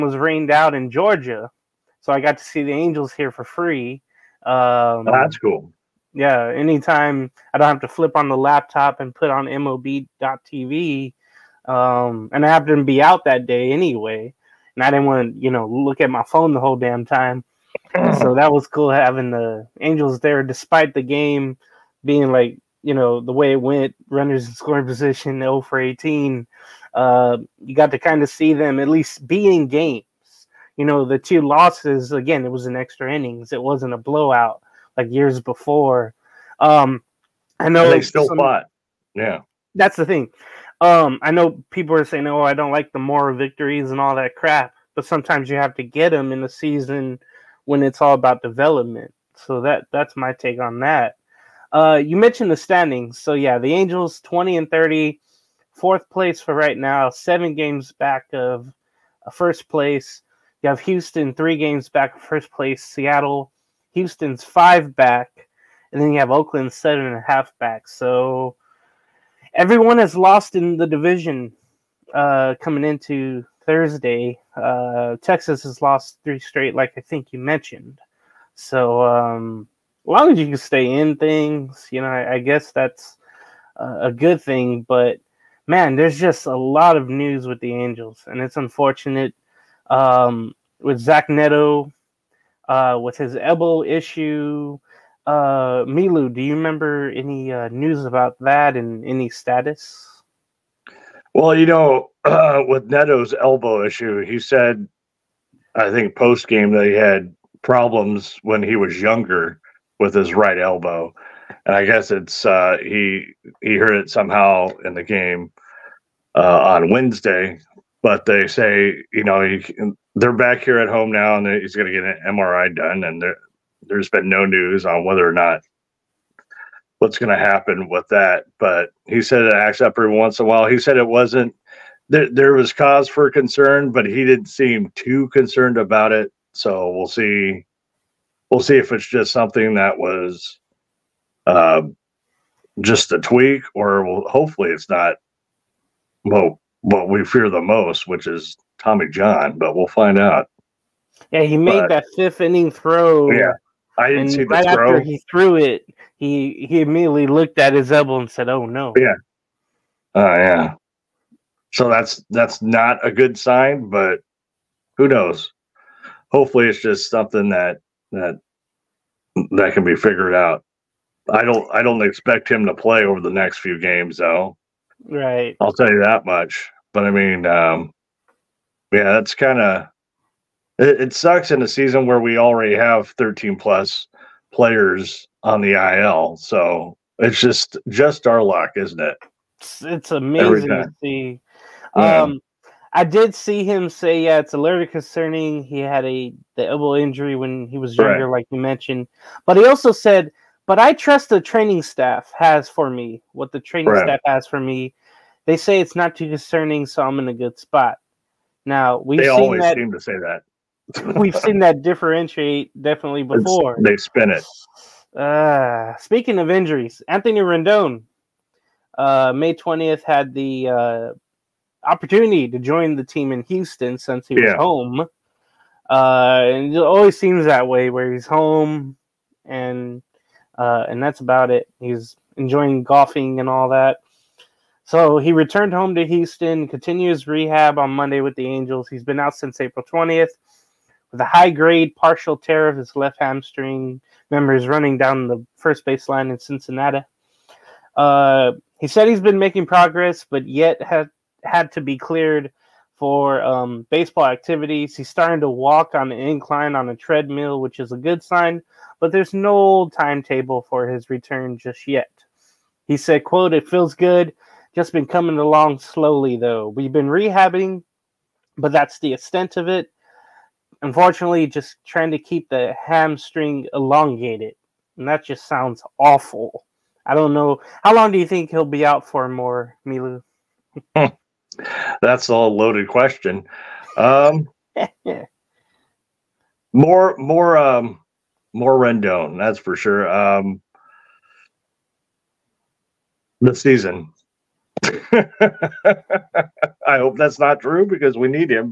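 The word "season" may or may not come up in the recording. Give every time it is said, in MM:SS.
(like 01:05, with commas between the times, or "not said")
00:46, 03:01, 04:53.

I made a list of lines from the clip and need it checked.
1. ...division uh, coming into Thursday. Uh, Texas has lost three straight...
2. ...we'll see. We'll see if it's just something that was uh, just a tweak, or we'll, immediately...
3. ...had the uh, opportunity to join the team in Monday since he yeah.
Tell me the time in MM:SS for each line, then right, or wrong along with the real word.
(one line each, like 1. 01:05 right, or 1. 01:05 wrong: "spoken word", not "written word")
1. 01:10 right
2. 02:16 wrong: "hopefully", not "immediately"
3. 03:40 wrong: "Houston", not "Monday".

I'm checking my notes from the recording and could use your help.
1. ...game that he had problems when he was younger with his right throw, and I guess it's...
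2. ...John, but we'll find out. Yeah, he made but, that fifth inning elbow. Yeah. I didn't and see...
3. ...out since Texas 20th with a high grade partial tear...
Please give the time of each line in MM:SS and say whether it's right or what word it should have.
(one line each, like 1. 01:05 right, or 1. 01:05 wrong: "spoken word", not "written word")
1. 01:46 wrong: "elbow", not "throw"
2. 02:29 wrong: "throw", not "elbow"
3. 03:59 wrong: "April", not "Texas".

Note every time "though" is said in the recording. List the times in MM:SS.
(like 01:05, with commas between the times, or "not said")
02:54, 04:26.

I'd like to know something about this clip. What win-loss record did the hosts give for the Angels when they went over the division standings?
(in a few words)
20-30.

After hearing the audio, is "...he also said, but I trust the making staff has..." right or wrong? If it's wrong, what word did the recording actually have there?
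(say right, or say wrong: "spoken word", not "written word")
wrong: "training", not "making".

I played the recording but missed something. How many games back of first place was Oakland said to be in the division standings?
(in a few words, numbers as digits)
7.5.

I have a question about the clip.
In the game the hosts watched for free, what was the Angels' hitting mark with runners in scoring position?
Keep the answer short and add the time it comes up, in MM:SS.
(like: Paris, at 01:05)
0 for 18, at 00:25.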